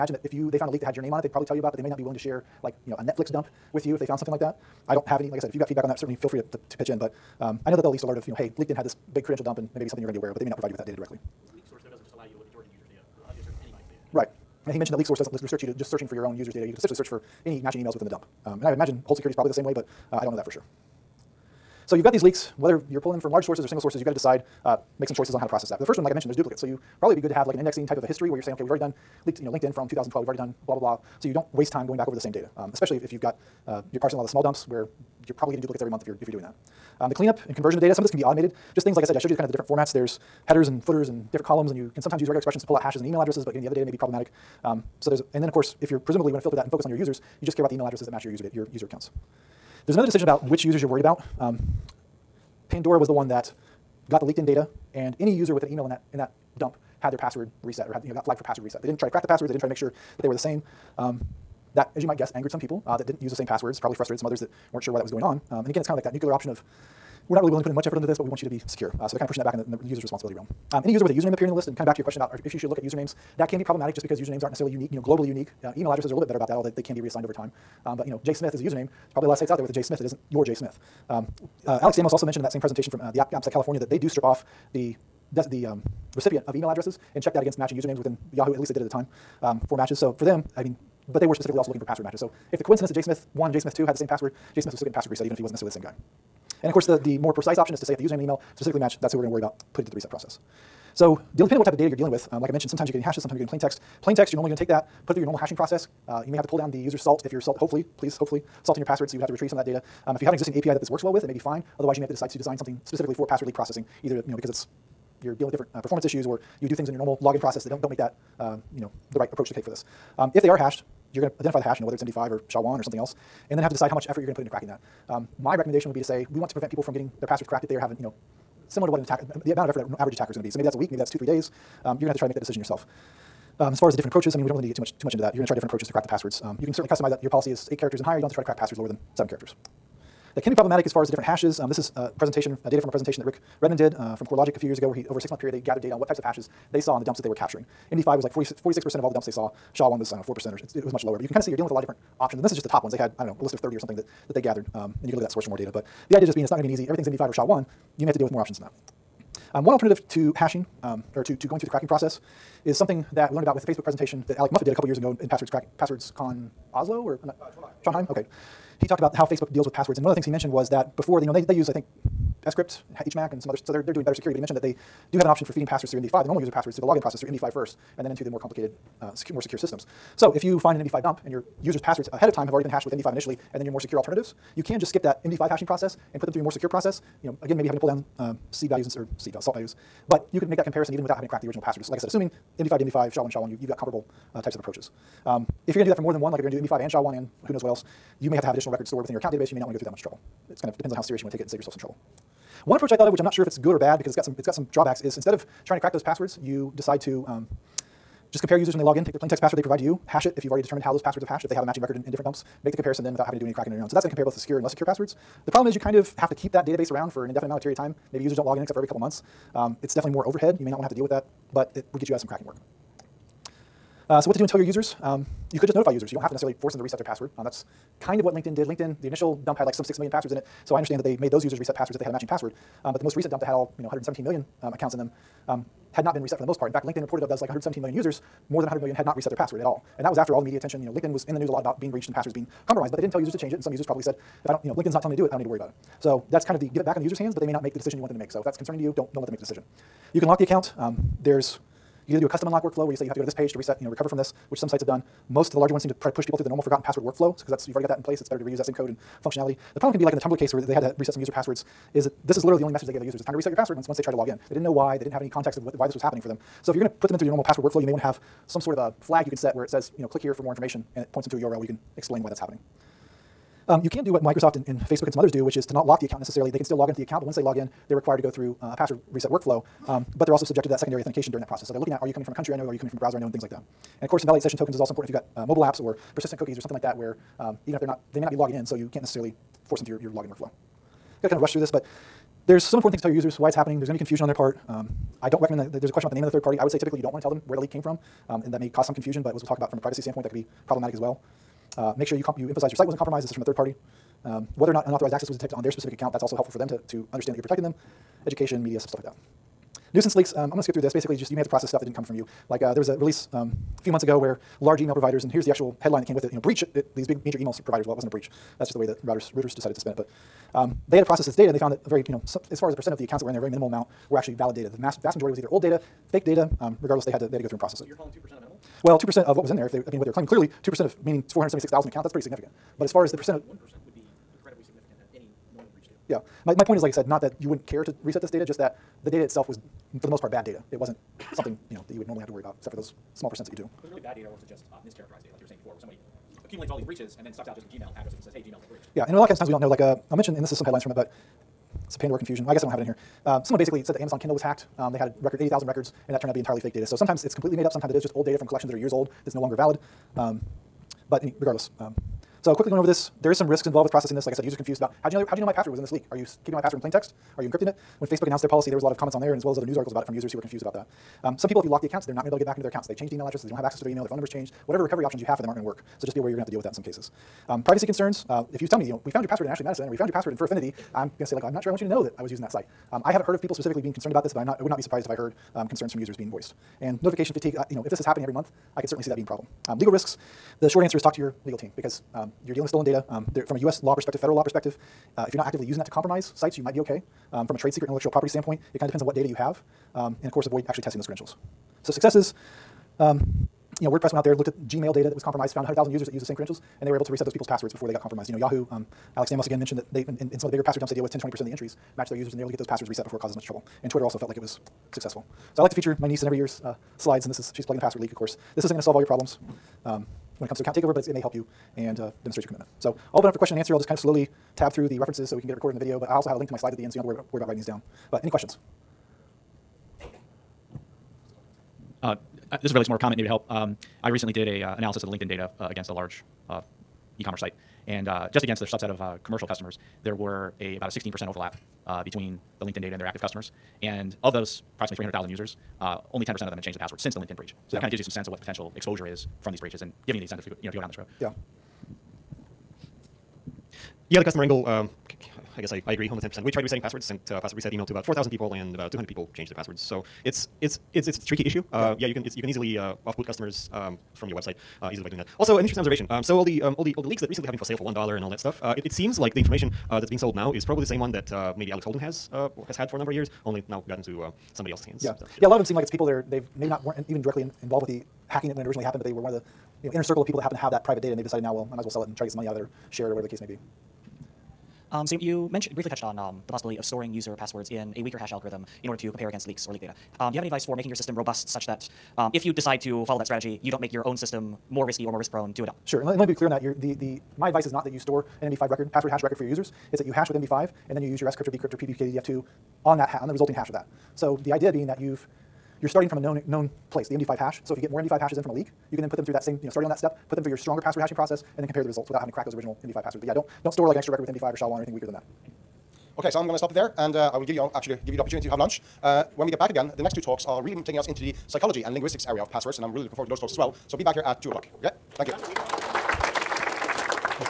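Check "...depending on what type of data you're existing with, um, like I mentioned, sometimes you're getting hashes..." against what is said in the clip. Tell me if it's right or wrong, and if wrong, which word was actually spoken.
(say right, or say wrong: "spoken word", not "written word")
wrong: "dealing", not "existing".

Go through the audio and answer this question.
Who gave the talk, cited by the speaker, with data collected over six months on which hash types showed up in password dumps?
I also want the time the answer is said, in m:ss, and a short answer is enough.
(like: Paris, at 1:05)
Rick Redman, at 2:23.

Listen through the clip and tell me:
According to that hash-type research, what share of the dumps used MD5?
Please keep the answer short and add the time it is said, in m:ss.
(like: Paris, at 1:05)
46 percent, at 2:28.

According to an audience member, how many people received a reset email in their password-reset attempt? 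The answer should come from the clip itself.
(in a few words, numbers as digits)
4,000.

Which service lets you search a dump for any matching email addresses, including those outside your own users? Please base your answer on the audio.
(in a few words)
LeakSource.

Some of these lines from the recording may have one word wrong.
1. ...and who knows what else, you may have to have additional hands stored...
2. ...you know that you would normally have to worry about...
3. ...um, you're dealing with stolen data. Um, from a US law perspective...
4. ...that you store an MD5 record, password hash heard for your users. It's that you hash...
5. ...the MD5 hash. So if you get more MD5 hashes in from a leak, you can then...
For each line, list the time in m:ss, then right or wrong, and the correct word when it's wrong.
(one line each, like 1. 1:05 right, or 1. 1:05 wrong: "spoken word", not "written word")
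1. 3:17 wrong: "records", not "hands"
2. 5:41 right
3. 6:32 right
4. 8:17 wrong: "record", not "heard"
5. 8:27 right.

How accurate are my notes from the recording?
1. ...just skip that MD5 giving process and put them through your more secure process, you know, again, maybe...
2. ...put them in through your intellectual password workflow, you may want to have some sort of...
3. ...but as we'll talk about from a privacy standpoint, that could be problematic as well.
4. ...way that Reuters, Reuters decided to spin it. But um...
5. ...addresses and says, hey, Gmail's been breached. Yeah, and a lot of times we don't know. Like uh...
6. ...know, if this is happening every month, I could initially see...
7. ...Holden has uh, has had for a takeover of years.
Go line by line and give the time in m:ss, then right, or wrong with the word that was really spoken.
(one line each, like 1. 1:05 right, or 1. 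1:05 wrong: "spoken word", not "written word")
1. 3:04 wrong: "hashing", not "giving"
2. 4:26 wrong: "normal", not "intellectual"
3. 4:59 right
4. 5:18 right
5. 5:47 right
6. 6:27 wrong: "certainly", not "initially"
7. 7:51 wrong: "number", not "takeover".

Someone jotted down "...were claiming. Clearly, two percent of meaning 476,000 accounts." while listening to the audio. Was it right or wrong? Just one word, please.
right.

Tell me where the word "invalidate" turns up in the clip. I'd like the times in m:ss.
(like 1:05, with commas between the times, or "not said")
4:44.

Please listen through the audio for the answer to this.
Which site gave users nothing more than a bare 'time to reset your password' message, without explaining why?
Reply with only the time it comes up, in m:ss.
4:20.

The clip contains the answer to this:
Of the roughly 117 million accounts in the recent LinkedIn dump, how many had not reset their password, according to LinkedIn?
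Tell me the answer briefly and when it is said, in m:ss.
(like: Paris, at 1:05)
more than 100 million, at 3:58.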